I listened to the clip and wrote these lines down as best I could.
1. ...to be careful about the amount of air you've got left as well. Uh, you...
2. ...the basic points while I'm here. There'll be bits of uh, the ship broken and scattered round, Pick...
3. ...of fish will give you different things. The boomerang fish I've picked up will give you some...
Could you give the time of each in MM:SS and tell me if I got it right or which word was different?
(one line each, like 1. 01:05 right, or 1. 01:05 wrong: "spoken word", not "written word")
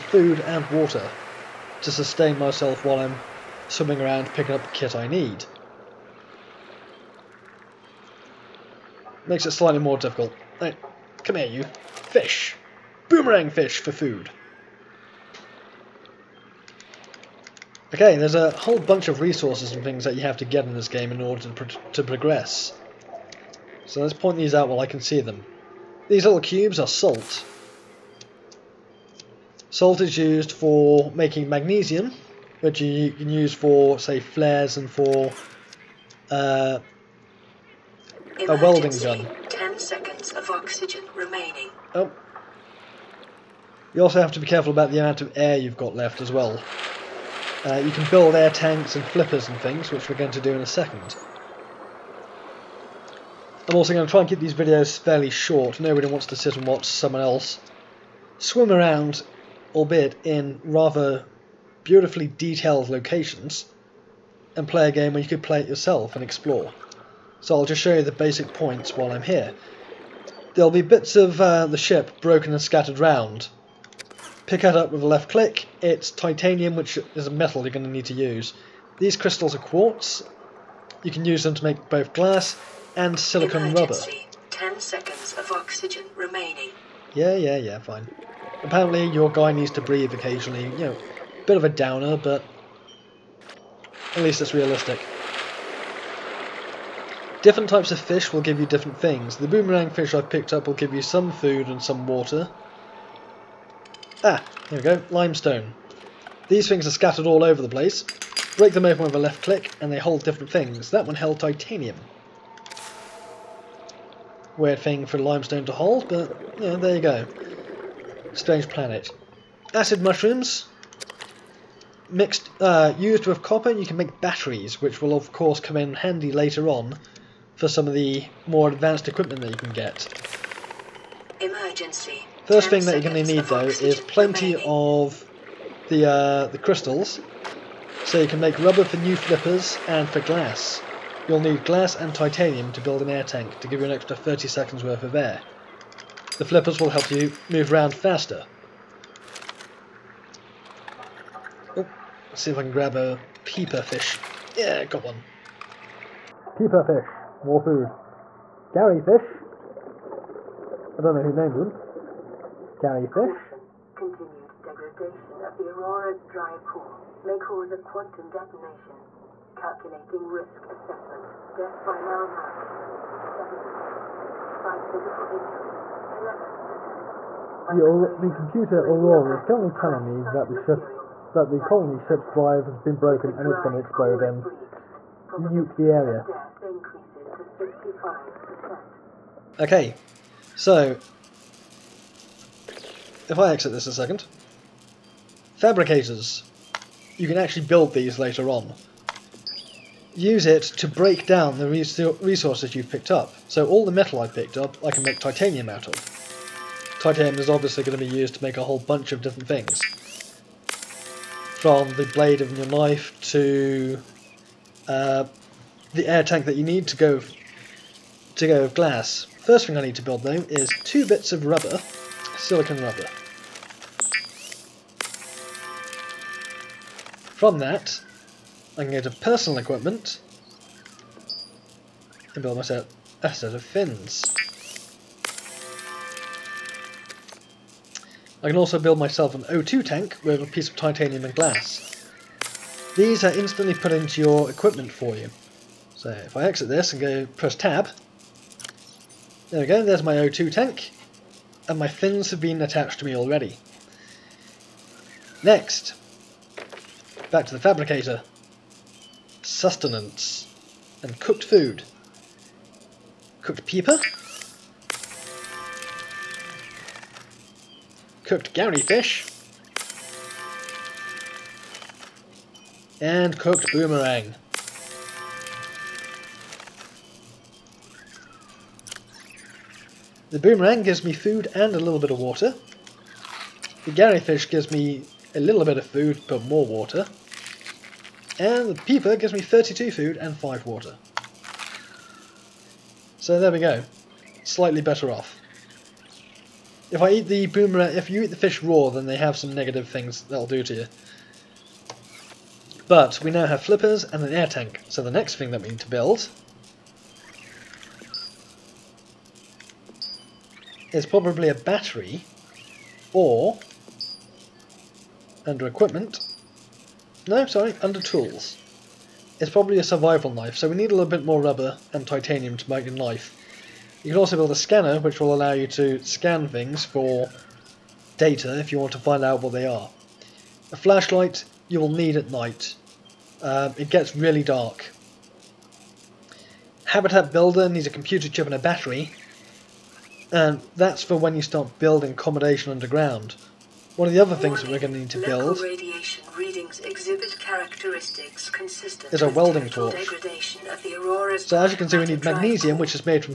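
1. 00:44 right
2. 01:08 right
3. 01:37 right.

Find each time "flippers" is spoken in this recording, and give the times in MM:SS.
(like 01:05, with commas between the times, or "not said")
00:49, 02:19, 02:26, 05:03.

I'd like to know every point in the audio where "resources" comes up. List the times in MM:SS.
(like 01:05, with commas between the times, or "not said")
00:19, 03:22.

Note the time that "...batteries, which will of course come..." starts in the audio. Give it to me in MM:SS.
02:04.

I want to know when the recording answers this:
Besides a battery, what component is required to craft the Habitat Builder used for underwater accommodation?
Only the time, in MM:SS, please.
05:37.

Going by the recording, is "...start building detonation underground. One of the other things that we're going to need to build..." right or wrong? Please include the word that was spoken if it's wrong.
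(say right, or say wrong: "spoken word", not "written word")
wrong: "accommodation", not "detonation".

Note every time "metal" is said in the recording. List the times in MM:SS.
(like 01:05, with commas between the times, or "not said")
01:17, 03:23.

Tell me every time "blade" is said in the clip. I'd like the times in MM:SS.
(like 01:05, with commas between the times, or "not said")
03:32.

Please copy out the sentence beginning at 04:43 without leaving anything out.
The gary fish gives me a little bit of food but more water.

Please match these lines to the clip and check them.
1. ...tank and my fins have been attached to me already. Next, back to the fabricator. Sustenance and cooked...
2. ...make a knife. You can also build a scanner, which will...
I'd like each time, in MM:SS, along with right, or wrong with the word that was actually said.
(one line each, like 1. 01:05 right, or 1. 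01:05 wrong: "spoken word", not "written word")
1. 04:10 right
2. 05:22 right.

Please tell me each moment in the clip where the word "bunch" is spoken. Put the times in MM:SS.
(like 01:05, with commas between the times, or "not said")
00:18, 03:28.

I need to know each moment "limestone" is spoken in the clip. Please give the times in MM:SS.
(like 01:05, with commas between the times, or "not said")
01:45, 01:55.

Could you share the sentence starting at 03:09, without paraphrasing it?
Okay, so if I exit this a second, fabricators, you can actually build these later on.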